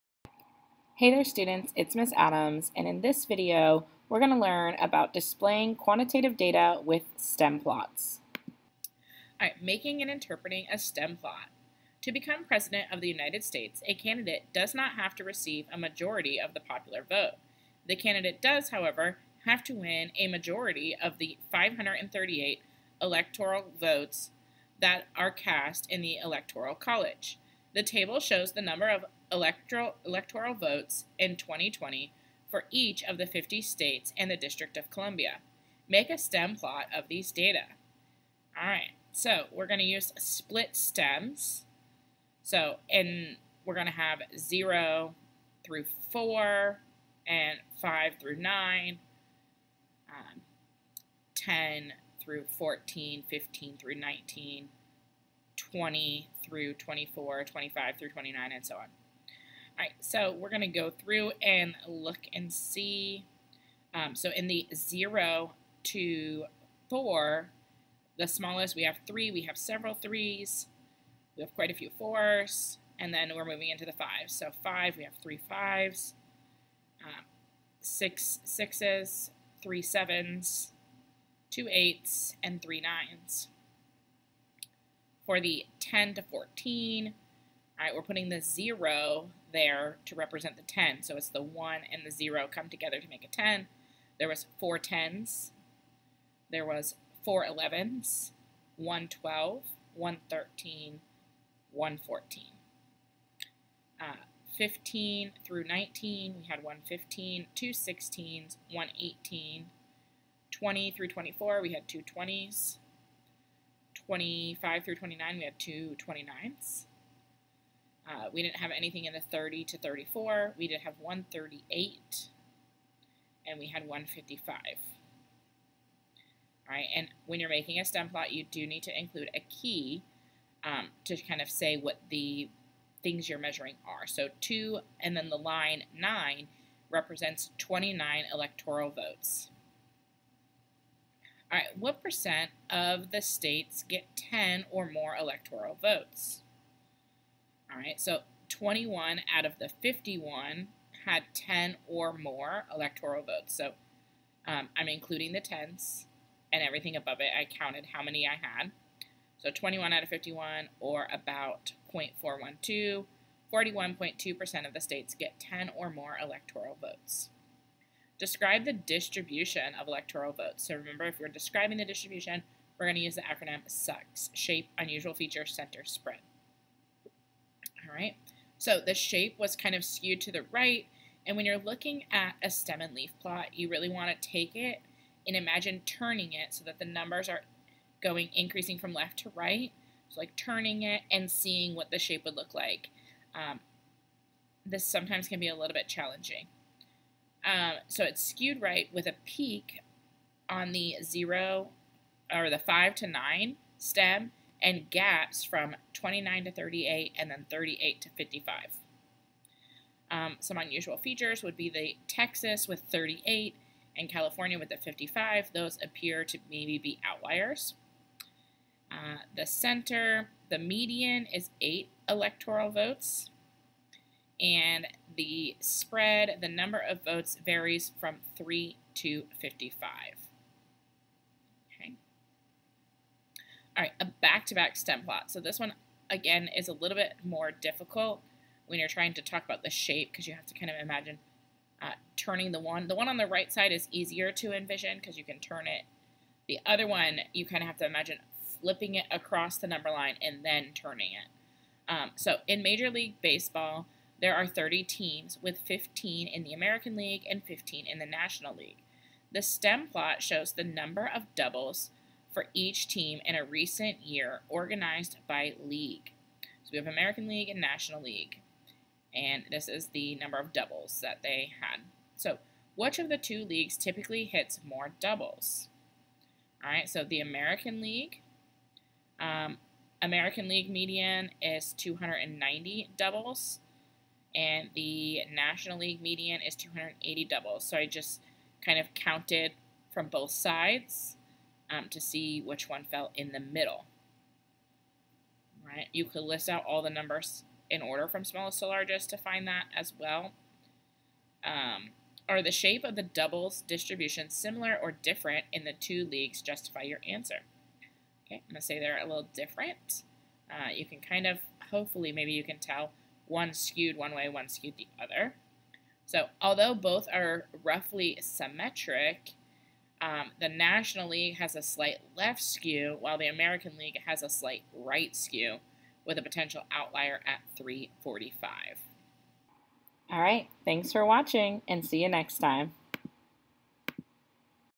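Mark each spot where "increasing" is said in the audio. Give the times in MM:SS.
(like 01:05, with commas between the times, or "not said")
03:08.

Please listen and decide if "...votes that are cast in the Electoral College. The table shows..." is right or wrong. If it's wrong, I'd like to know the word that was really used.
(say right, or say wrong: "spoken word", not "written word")
right.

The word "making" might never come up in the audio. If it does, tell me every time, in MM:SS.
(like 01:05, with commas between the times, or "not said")
00:09, 02:07.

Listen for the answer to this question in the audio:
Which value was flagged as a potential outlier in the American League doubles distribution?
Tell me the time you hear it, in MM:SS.
05:27.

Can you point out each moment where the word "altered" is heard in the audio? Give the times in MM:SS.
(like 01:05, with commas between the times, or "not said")
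not said.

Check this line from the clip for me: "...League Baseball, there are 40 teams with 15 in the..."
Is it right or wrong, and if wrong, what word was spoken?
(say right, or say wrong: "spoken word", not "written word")
wrong: "30", not "40".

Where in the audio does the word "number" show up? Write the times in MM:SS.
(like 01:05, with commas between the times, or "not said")
00:28, 03:06, 03:46, 04:09, 04:20, 04:30, 04:56.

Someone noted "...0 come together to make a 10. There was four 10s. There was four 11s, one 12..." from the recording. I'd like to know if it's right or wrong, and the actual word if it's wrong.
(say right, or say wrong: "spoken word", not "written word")
right.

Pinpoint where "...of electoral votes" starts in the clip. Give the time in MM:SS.
02:49.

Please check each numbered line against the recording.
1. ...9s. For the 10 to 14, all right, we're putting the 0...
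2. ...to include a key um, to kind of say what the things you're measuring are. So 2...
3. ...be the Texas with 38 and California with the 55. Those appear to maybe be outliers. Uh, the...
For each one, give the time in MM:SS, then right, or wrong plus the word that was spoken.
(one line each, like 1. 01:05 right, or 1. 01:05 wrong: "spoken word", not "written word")
1. 01:23 right
2. 02:08 right
3. 03:31 right.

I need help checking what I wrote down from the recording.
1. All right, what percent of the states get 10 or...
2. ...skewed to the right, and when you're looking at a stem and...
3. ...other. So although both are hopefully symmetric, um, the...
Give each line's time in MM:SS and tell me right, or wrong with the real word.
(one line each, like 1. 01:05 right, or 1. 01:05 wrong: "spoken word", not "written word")
1. 02:21 right
2. 02:59 right
3. 05:15 wrong: "roughly", not "hopefully".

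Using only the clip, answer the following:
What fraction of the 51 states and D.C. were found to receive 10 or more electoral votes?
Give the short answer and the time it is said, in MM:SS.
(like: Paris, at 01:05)
21 out of 51, at 02:28.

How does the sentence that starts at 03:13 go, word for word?
Um, this sometimes can be a little bit challenging.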